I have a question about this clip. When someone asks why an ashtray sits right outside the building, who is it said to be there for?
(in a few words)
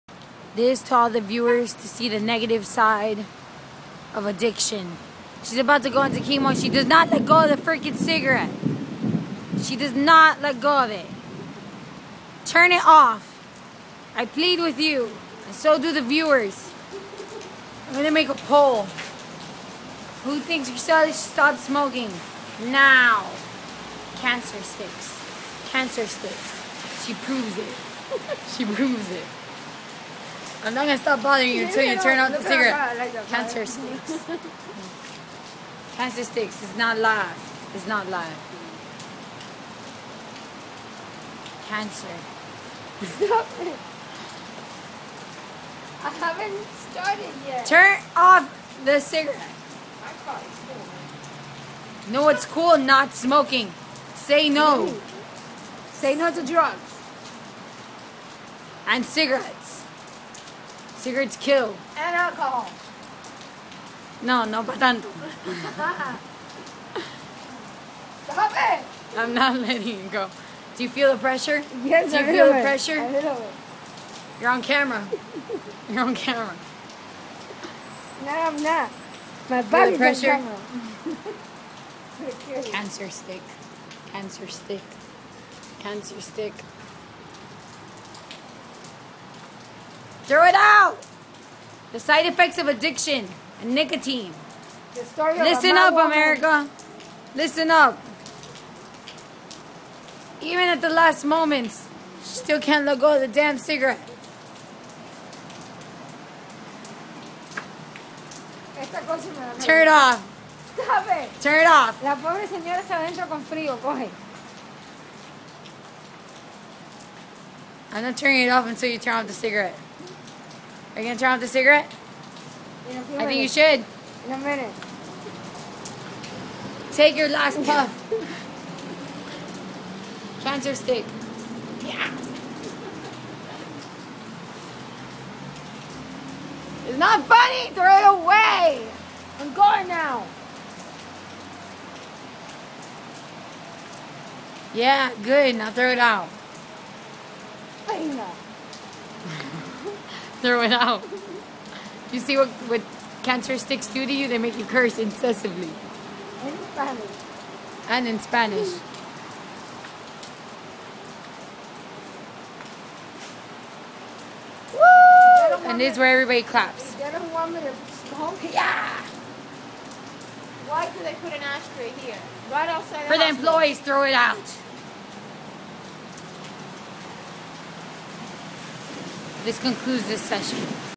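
The employees.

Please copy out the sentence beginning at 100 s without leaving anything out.
Even at the last moments, she still can't let go of the damn cigarette.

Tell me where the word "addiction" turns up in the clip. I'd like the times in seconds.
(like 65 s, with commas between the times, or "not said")
4 s, 92 s.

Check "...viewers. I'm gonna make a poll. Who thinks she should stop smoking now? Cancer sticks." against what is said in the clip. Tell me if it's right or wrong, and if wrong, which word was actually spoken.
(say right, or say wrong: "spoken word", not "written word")
right.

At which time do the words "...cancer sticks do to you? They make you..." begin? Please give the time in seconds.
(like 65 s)
153 s.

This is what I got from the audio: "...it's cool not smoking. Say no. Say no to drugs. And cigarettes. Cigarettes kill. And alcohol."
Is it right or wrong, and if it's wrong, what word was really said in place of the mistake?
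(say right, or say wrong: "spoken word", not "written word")
right.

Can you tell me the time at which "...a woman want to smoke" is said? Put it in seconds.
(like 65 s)
167 s.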